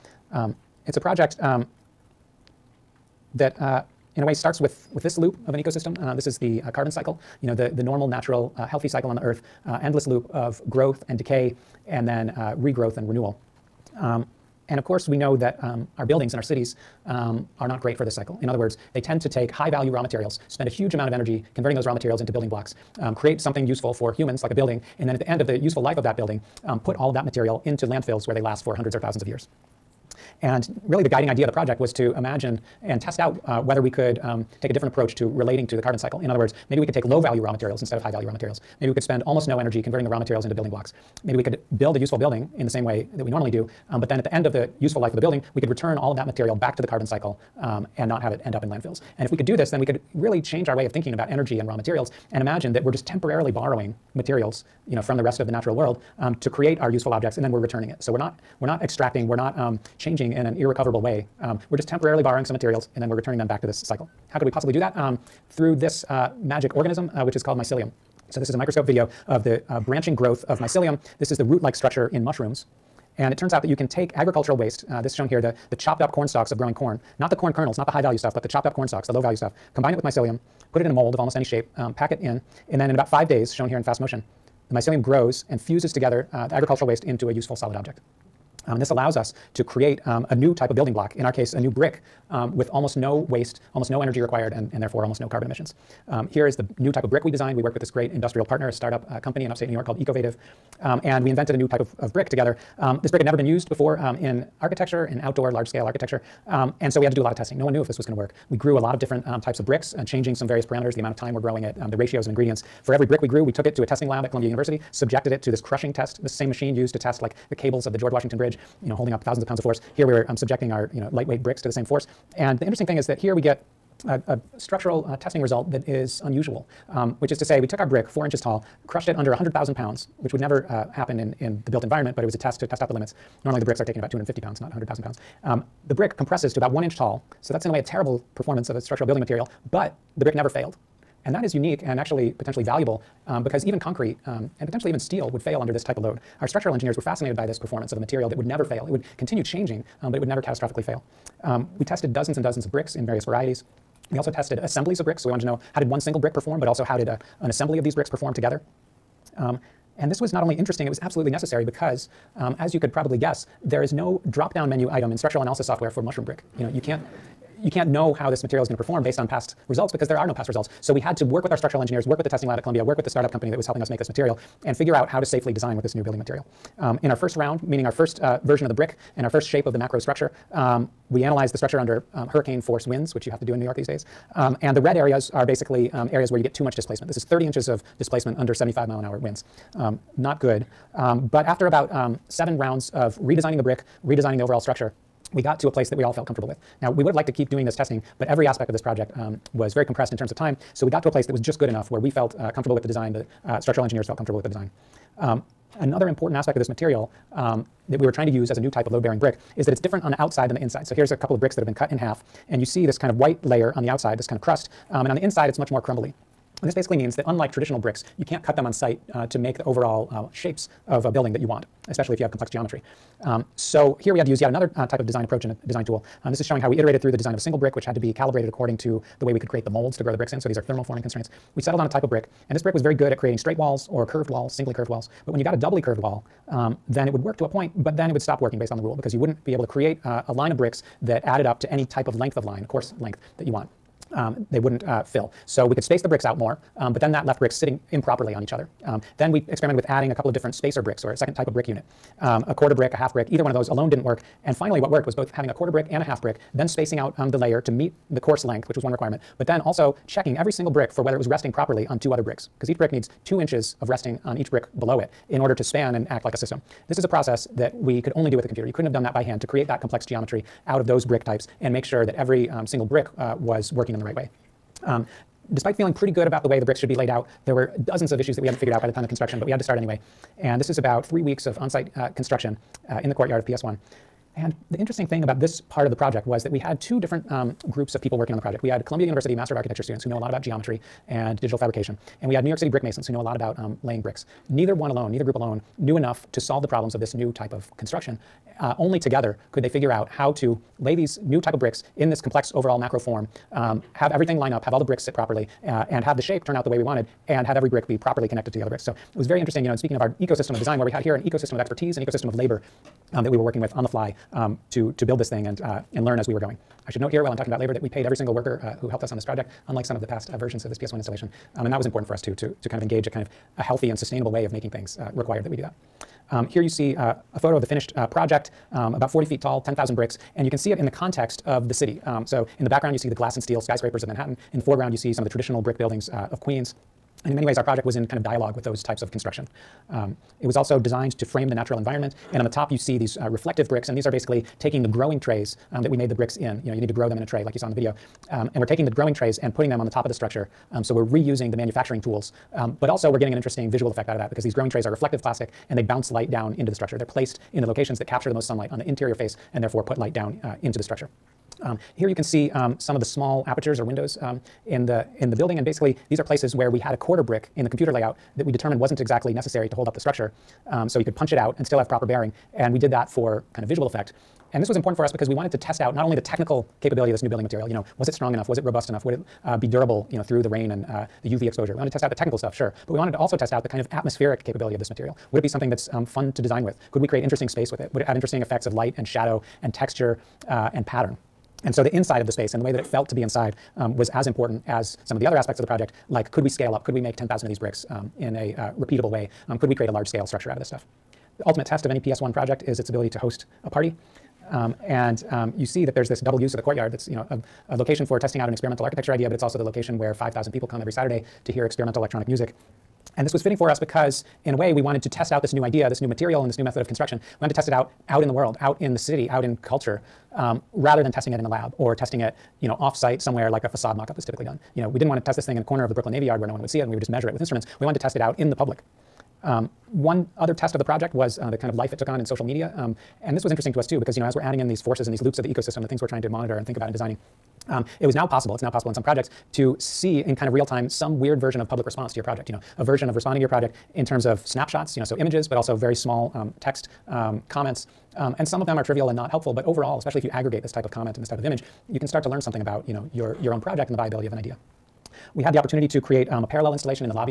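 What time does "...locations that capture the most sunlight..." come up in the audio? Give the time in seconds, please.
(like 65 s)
357 s.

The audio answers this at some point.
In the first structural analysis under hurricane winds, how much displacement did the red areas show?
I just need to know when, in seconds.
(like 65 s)
187 s.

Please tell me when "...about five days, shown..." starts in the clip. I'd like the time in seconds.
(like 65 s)
82 s.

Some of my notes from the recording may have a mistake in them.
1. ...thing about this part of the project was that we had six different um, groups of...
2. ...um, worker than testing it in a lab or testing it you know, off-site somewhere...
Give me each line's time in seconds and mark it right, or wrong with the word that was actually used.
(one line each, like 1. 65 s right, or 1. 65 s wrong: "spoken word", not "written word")
1. 285 s wrong: "two", not "six"
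2. 420 s wrong: "rather", not "worker".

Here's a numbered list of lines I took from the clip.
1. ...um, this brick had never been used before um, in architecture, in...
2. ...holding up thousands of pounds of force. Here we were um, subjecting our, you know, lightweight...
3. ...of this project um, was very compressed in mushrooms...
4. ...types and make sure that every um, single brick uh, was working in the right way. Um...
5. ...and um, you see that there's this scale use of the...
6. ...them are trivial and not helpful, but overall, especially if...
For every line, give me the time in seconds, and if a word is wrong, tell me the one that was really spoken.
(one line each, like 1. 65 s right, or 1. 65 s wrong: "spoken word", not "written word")
1. 102 s right
2. 118 s right
3. 198 s wrong: "terms", not "mushrooms"
4. 271 s right
5. 404 s wrong: "double", not "scale"
6. 448 s right.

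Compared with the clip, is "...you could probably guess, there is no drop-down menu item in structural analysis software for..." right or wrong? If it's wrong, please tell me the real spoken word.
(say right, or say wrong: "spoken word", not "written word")
right.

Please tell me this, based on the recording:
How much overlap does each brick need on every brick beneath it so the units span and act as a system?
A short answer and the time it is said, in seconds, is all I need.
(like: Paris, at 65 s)
2 inches, at 263 s.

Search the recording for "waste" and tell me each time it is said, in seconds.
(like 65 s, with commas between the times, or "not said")
74 s, 86 s, 93 s.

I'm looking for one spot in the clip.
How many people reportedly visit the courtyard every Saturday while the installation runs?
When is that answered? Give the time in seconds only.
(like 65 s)
410 s.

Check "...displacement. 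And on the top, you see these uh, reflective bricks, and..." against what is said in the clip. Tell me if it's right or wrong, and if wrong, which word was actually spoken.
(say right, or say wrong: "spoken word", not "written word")
wrong: "environment", not "displacement".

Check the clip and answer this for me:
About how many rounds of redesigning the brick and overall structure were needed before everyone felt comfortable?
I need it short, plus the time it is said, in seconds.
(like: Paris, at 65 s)
7, at 192 s.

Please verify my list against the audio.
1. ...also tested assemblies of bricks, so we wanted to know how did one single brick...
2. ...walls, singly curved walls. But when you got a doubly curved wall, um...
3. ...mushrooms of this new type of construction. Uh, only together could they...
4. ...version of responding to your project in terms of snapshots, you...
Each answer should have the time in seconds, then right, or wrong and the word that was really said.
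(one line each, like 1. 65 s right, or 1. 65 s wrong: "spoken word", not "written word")
1. 154 s right
2. 234 s right
3. 296 s wrong: "problems", not "mushrooms"
4. 442 s right.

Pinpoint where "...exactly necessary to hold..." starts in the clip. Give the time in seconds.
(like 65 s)
368 s.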